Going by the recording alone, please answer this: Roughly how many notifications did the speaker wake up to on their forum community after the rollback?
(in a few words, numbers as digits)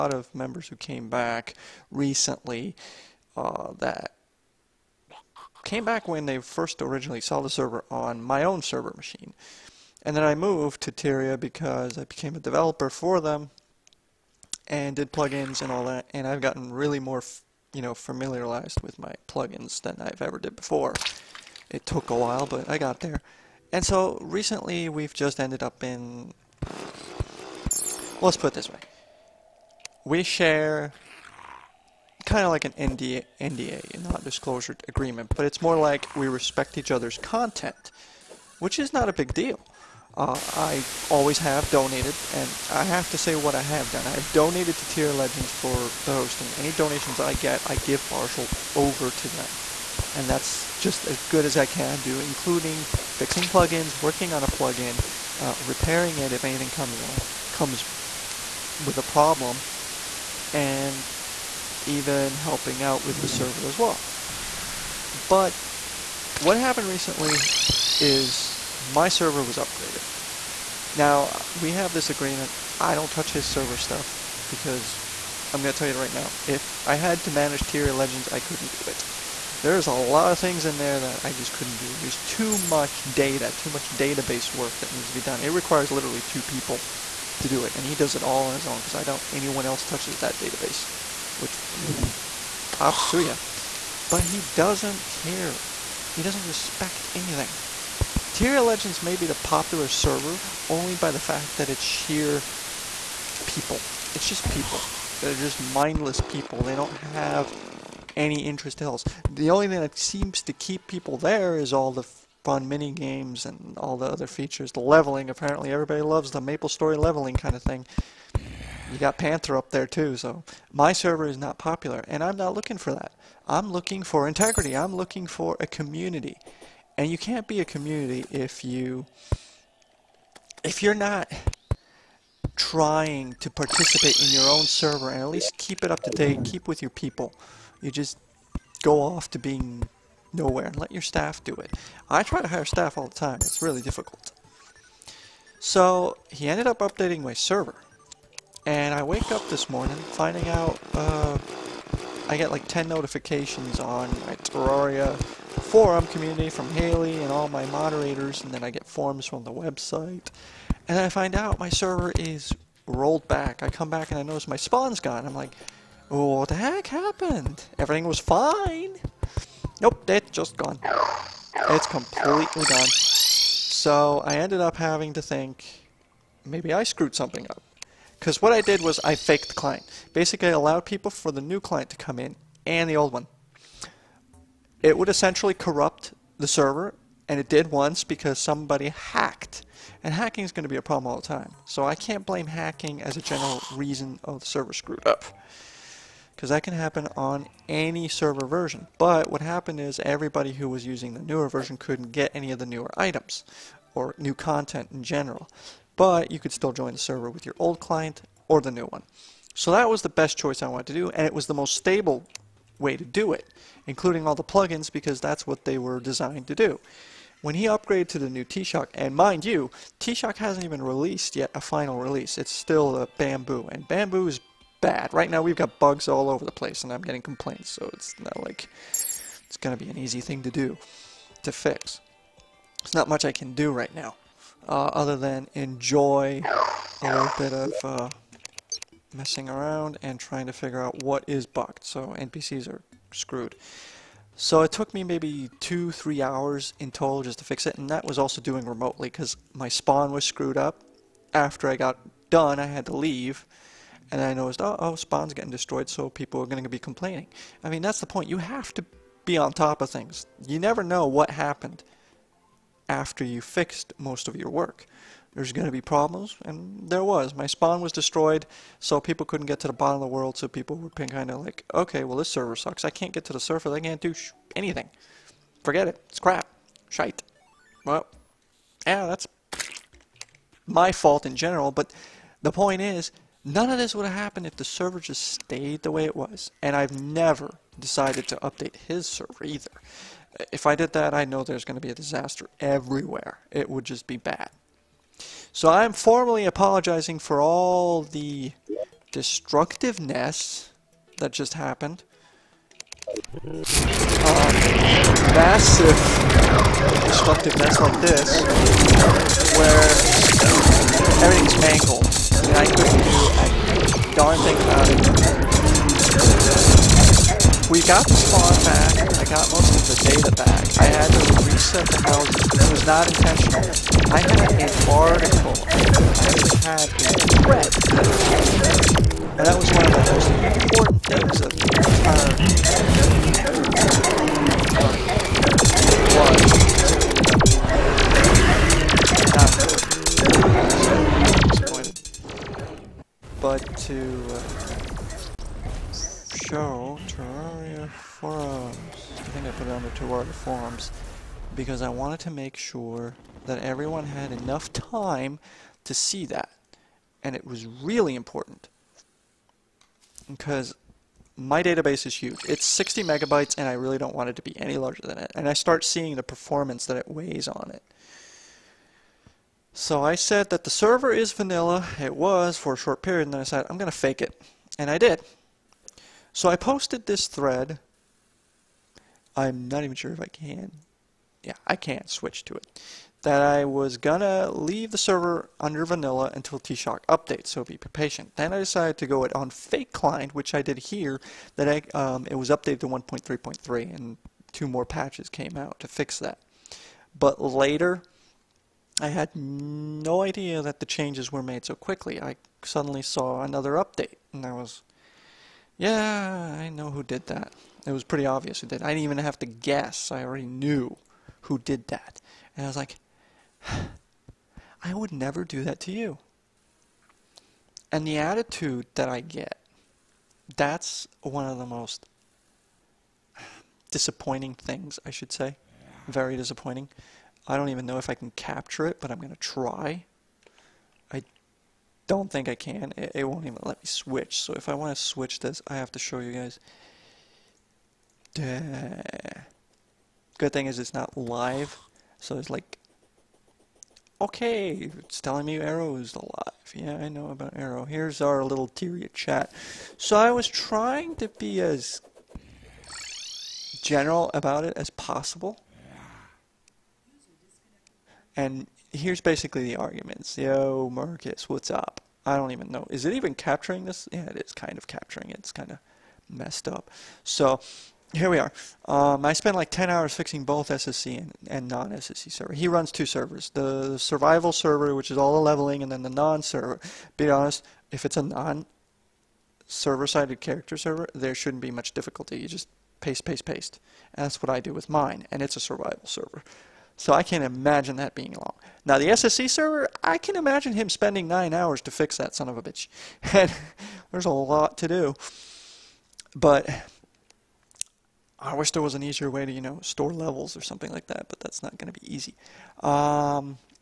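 10.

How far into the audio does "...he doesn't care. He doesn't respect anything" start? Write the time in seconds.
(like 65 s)
94 s.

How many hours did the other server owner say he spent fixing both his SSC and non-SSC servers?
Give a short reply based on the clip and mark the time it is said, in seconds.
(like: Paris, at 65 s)
10, at 469 s.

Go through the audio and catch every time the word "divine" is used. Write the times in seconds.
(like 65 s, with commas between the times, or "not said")
not said.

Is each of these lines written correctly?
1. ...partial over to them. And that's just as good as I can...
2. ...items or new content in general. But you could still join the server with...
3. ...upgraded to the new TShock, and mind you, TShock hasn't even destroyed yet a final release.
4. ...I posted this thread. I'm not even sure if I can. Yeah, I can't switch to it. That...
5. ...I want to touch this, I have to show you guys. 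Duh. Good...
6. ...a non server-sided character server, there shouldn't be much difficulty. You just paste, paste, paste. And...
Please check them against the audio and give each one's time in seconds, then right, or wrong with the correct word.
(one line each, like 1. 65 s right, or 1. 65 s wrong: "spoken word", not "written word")
1. 48 s right
2. 202 s right
3. 217 s wrong: "released", not "destroyed"
4. 376 s right
5. 434 s wrong: "switch", not "touch"
6. 478 s right.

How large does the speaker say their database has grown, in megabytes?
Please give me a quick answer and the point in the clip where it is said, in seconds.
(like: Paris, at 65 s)
60 megabytes, at 362 s.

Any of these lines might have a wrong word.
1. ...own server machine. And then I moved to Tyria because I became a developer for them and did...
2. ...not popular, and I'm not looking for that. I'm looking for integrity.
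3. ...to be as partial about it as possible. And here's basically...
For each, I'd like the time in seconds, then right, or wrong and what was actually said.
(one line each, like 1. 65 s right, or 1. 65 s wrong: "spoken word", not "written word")
1. 8 s right
2. 121 s right
3. 451 s wrong: "general", not "partial".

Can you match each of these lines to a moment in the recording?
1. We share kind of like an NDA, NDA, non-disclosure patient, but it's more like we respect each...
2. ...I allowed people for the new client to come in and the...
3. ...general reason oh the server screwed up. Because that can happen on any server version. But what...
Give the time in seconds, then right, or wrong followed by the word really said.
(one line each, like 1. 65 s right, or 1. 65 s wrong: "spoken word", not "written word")
1. 30 s wrong: "agreement", not "patient"
2. 180 s right
3. 193 s right.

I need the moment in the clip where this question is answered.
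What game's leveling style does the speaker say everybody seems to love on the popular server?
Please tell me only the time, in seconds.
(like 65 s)
116 s.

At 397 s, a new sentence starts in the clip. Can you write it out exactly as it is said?
But later, I had no idea that the changes were made so quickly.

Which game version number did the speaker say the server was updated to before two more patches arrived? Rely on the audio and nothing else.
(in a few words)
1.3.3.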